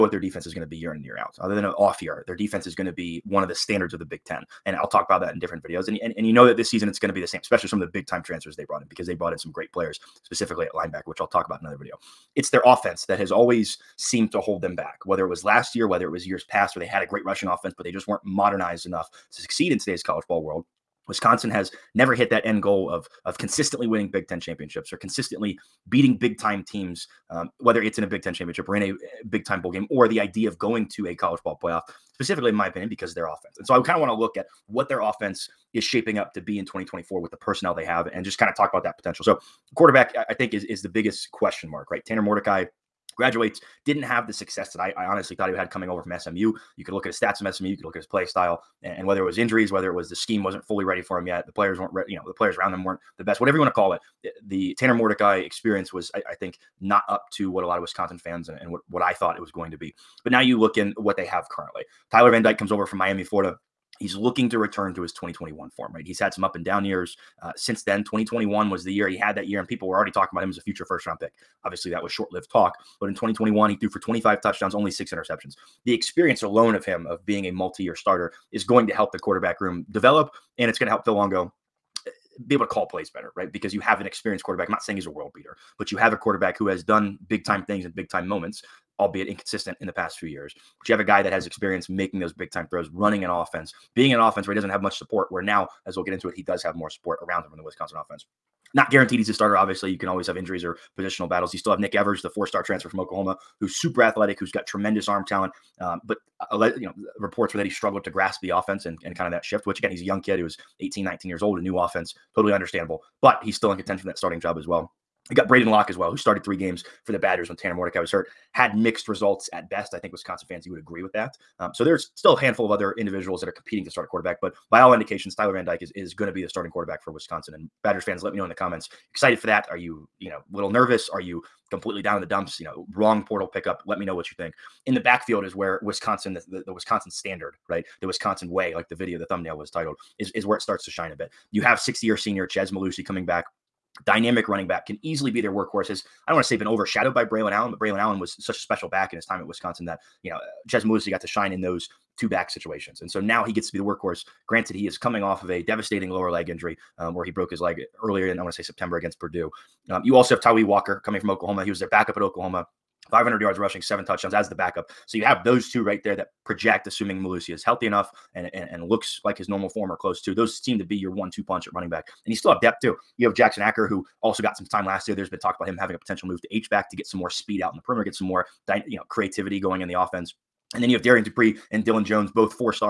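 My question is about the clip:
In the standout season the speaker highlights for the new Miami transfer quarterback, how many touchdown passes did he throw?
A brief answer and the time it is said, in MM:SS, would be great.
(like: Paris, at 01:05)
25, at 01:13.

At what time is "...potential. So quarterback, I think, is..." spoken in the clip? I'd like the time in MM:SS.
00:38.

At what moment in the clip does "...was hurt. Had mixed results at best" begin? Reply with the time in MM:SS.
01:57.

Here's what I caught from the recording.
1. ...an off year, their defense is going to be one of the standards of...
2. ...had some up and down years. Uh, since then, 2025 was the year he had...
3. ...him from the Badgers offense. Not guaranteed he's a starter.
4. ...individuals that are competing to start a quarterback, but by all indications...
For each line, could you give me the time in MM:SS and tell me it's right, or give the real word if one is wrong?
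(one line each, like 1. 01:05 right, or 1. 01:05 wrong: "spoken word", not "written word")
1. 00:01 right
2. 01:06 wrong: "2021", not "2025"
3. 01:37 wrong: "Wisconsin", not "Badgers"
4. 02:02 right.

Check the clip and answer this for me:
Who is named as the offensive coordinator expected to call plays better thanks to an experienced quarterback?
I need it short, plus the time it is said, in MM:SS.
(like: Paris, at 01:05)
Phil Longo, at 01:21.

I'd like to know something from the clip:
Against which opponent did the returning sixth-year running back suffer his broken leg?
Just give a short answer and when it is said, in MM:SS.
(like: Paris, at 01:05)
Purdue, at 02:39.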